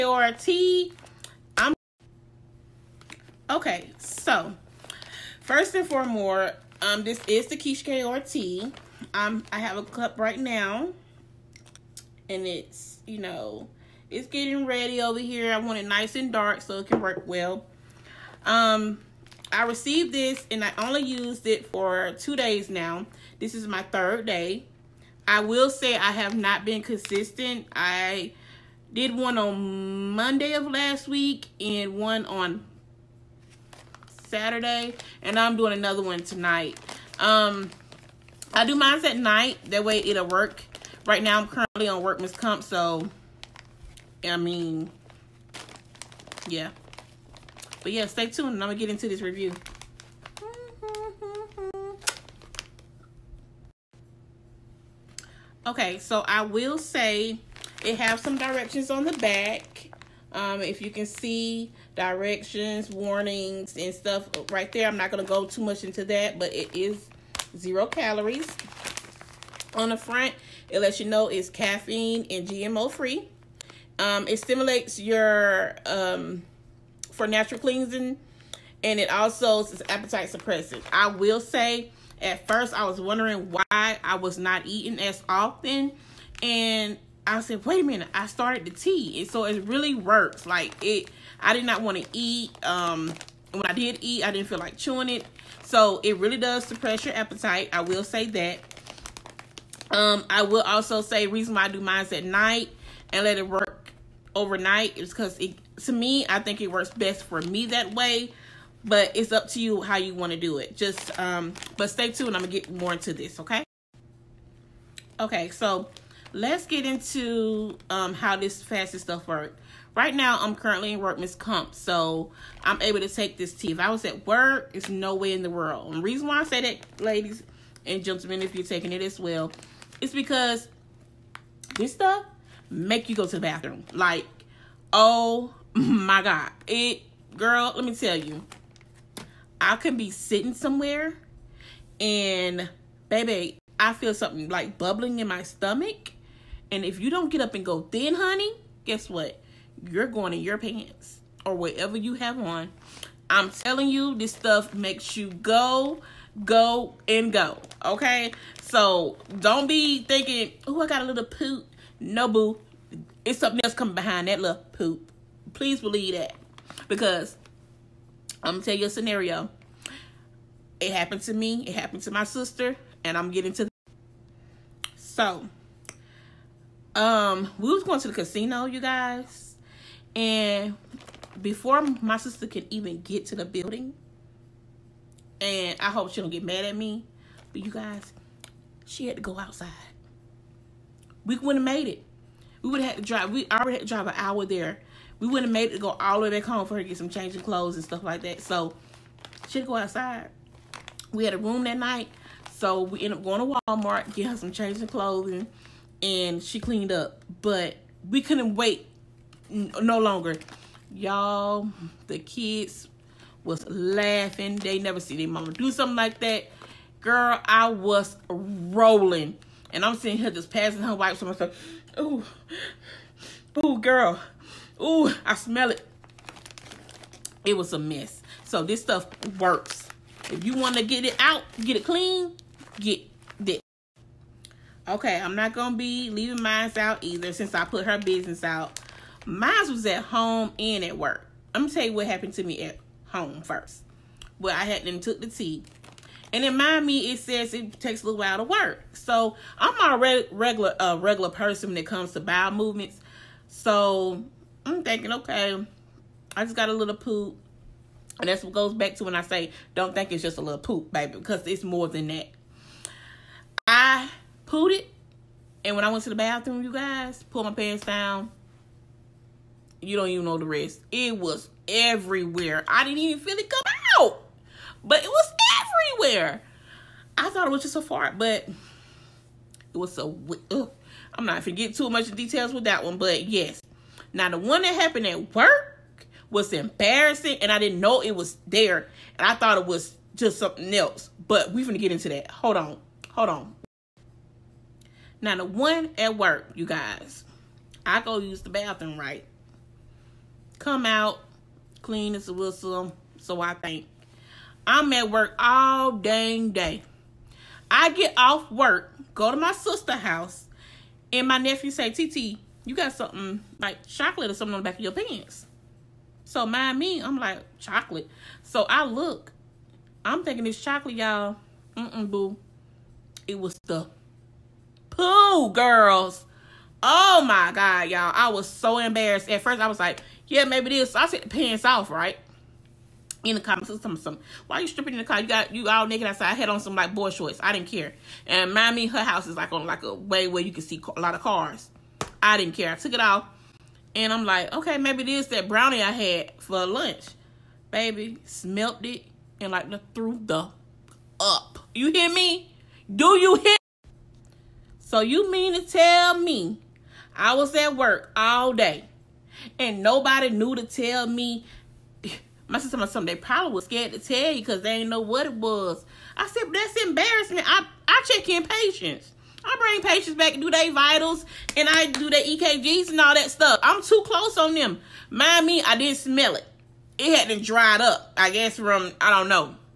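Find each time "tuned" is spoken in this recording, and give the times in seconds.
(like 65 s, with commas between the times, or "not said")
48 s, 112 s.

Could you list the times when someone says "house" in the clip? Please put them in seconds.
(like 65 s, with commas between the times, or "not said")
309 s, 339 s.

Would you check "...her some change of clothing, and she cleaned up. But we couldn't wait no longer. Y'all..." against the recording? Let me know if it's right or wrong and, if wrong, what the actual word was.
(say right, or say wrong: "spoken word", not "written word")
right.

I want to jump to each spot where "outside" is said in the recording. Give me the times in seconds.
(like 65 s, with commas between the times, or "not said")
189 s, 199 s, 336 s.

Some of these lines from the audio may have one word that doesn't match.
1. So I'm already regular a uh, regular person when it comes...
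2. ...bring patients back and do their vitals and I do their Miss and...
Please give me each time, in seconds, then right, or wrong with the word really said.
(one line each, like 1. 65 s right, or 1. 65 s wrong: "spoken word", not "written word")
1. 248 s right
2. 369 s wrong: "EKGs", not "Miss".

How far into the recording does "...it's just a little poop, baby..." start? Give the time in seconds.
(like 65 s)
260 s.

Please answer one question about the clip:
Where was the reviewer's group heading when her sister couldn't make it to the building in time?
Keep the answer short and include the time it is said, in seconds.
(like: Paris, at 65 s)
the casino, at 178 s.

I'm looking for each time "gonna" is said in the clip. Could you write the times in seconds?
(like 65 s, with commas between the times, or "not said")
48 s, 112 s, 241 s, 291 s.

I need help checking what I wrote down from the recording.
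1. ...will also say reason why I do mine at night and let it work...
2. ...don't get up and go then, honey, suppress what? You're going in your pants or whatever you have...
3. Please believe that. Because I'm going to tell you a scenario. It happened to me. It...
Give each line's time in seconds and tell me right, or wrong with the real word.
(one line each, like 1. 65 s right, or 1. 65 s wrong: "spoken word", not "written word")
1. 100 s right
2. 147 s wrong: "guess", not "suppress"
3. 165 s right.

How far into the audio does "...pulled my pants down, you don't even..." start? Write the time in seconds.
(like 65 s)
267 s.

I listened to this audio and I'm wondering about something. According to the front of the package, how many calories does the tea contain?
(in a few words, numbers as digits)
zero.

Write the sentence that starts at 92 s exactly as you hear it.
Um, when I did eat, I didn't feel like chewing it.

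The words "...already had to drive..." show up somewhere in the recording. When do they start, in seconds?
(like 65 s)
193 s.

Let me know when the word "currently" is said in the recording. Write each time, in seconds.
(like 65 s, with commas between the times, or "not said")
41 s, 120 s.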